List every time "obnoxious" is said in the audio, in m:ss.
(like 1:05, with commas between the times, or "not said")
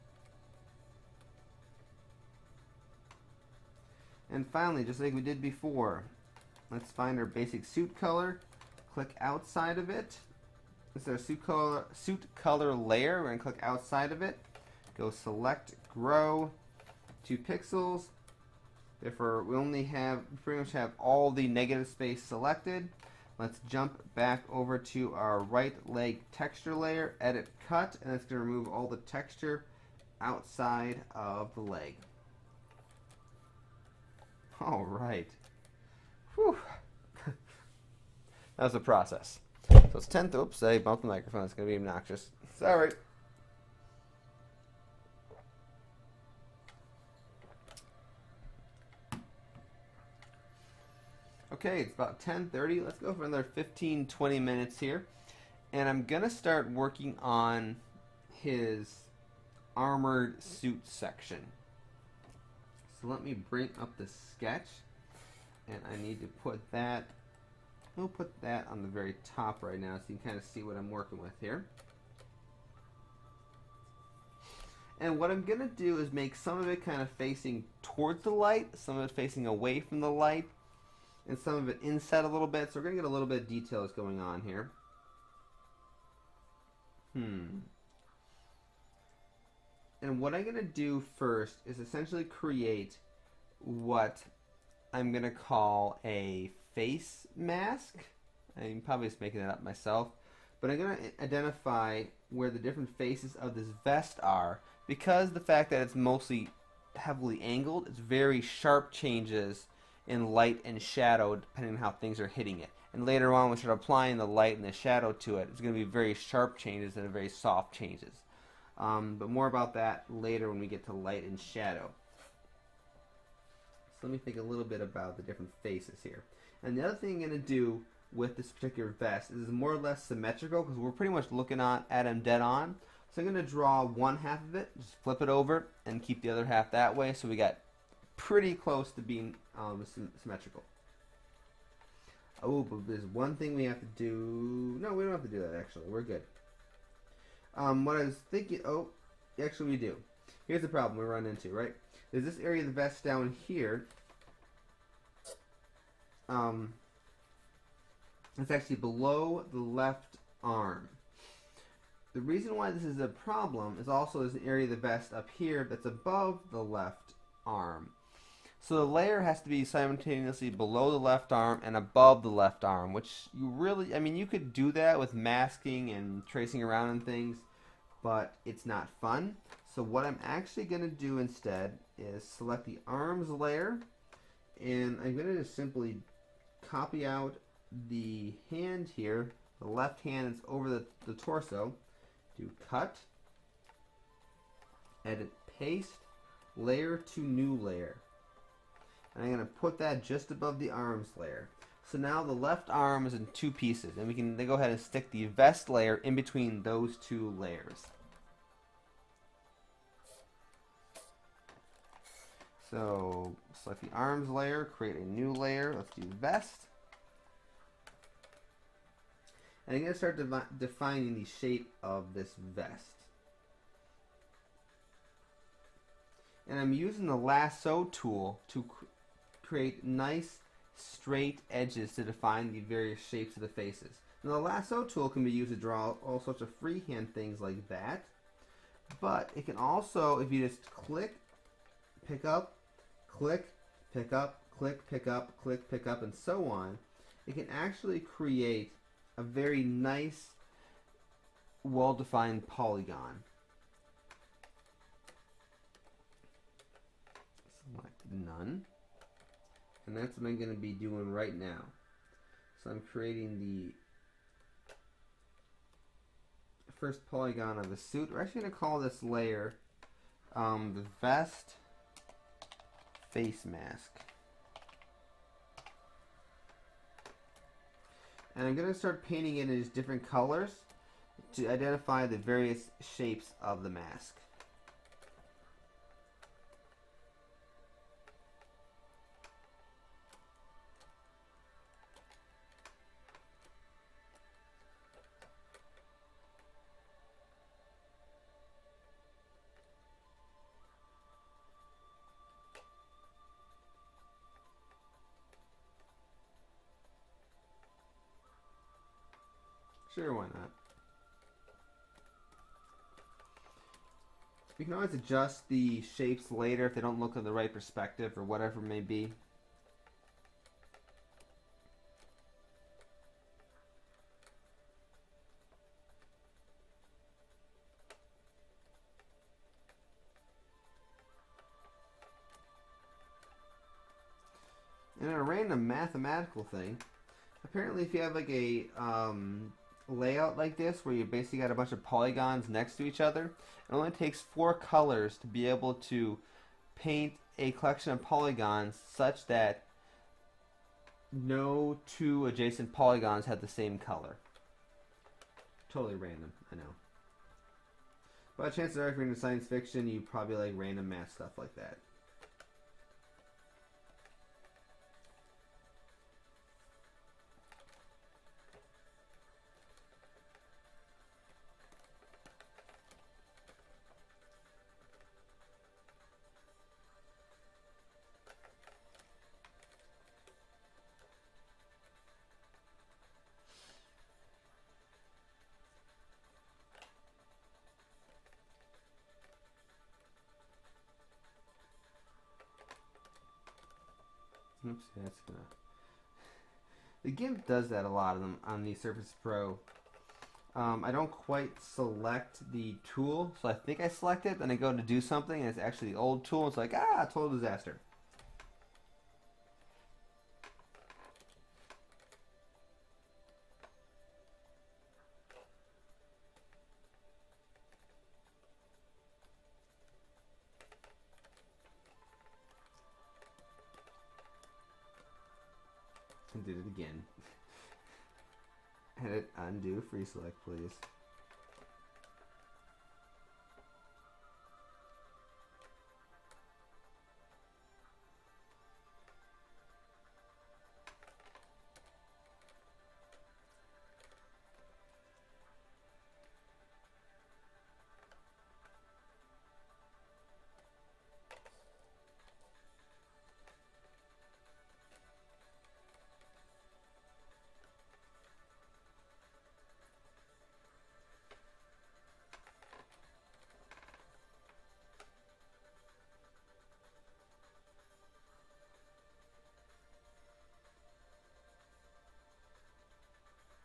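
0:41.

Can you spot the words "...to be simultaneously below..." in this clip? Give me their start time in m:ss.
2:49.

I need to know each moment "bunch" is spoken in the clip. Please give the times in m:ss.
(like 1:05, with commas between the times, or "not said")
5:41.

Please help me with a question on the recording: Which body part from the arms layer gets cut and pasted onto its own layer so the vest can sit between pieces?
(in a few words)
left hand.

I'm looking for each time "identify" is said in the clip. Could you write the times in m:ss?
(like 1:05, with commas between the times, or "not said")
1:41, 4:41.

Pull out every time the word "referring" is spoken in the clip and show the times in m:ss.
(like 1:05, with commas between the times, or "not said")
not said.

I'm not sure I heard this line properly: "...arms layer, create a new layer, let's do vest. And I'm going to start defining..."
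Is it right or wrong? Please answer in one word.
right.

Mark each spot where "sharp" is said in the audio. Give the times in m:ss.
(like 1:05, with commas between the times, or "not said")
1:48, 1:56.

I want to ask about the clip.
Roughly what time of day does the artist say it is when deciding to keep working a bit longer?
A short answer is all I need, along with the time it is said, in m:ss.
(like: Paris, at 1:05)
10:30, at 0:52.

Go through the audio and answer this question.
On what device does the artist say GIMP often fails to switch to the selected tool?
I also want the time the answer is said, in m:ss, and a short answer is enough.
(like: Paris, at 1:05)
Surface Pro, at 6:38.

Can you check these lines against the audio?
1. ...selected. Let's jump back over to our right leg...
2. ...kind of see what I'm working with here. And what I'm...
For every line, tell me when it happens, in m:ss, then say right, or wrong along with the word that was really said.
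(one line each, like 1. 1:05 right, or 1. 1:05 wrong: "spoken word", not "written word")
1. 0:22 right
2. 1:10 right.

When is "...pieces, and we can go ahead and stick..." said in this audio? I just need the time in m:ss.
3:23.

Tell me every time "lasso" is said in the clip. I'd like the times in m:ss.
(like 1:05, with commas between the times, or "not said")
3:47, 3:54.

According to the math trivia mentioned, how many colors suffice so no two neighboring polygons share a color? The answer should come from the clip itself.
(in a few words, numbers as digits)
4.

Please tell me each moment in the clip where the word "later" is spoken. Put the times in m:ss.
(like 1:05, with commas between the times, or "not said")
1:53, 2:00, 5:16.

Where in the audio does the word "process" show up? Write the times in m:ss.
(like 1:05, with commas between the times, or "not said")
0:38.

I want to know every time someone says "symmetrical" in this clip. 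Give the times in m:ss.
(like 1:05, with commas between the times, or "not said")
2:10, 2:20.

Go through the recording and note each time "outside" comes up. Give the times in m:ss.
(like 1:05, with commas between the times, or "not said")
0:09, 0:13, 0:30.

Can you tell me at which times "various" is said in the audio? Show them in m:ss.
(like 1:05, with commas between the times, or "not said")
3:52, 4:42.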